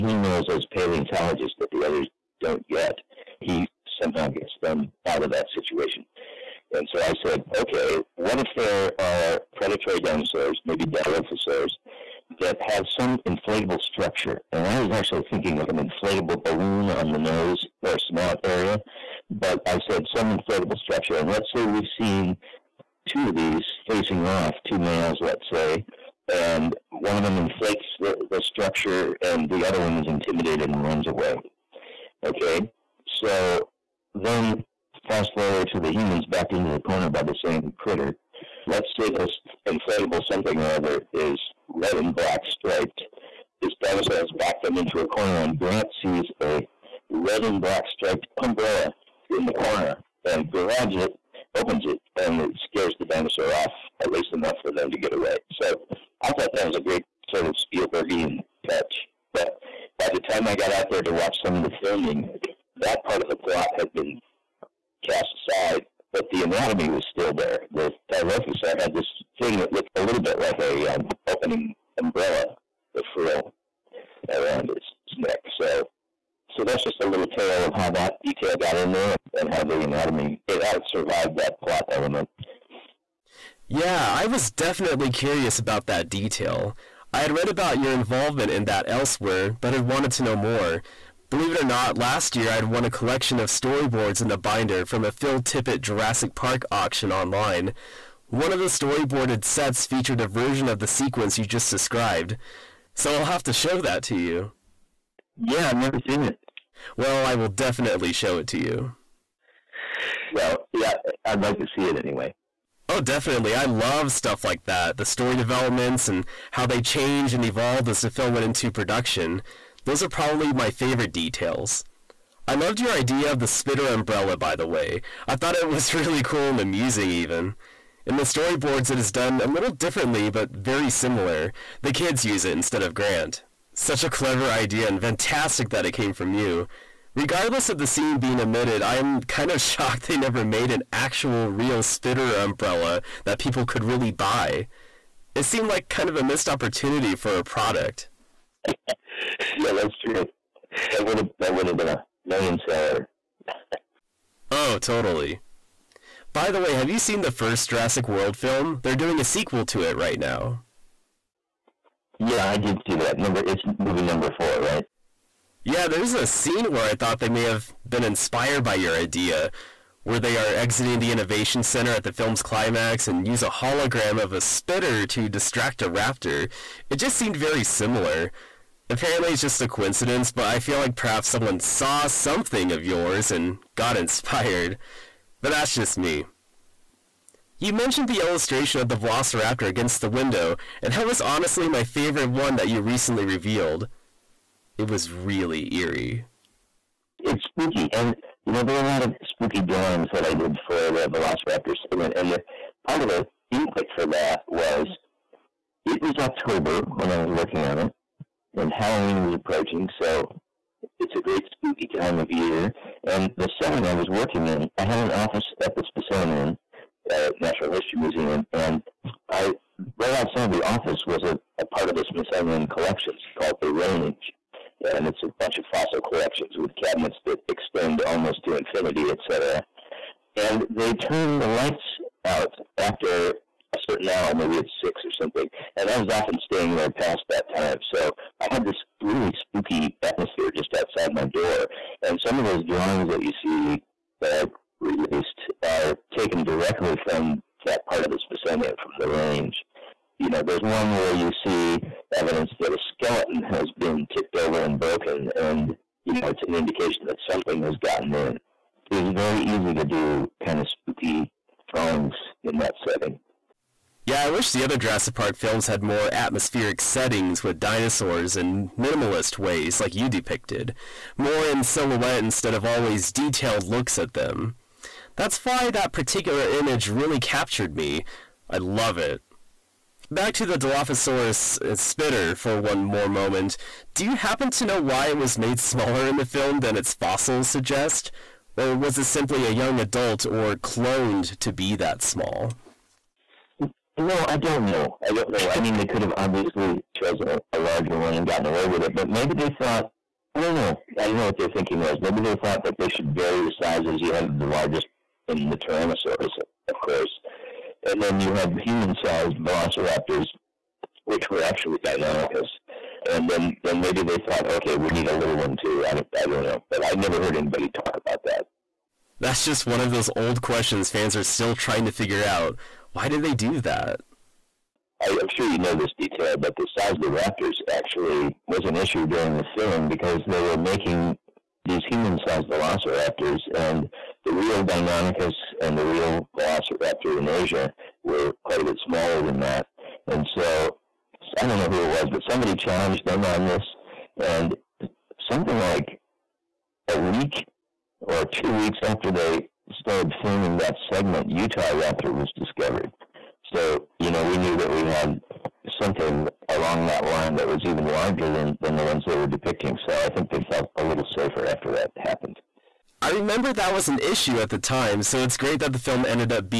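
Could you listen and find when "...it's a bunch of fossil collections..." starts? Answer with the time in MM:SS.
03:45.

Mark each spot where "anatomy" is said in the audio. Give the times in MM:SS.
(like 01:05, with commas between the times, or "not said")
01:06, 01:19.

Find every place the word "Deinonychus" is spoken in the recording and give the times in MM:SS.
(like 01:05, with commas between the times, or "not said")
05:11, 05:34.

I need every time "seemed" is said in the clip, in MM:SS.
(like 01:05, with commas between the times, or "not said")
02:25, 02:57.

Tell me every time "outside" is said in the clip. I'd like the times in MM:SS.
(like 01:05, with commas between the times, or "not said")
03:40, 04:00.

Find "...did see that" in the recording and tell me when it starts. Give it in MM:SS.
02:42.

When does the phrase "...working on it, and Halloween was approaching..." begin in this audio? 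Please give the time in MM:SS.
03:27.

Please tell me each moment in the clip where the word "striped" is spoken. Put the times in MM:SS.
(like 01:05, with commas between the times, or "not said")
00:42, 00:47.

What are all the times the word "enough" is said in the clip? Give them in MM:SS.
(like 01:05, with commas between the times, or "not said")
00:54.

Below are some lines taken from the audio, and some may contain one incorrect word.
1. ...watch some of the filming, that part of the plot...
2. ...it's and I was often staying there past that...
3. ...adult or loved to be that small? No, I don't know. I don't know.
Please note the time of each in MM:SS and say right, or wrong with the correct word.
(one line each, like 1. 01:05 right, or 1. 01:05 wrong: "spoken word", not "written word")
1. 01:01 right
2. 03:54 right
3. 04:49 wrong: "cloned", not "loved".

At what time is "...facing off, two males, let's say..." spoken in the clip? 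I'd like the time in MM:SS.
00:23.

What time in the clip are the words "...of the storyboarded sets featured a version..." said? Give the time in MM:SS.
01:38.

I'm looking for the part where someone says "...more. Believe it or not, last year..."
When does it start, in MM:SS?
01:30.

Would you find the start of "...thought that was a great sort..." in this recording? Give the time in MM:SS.
00:56.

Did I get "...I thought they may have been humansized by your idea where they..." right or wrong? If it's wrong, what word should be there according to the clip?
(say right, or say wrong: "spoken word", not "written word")
wrong: "inspired", not "humansized".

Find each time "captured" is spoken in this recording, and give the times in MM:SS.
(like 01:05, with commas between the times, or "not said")
04:37.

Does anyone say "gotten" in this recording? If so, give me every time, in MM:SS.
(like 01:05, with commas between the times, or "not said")
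04:17, 04:58.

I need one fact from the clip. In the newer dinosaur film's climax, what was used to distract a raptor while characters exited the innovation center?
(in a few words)
A hologram of a spitter.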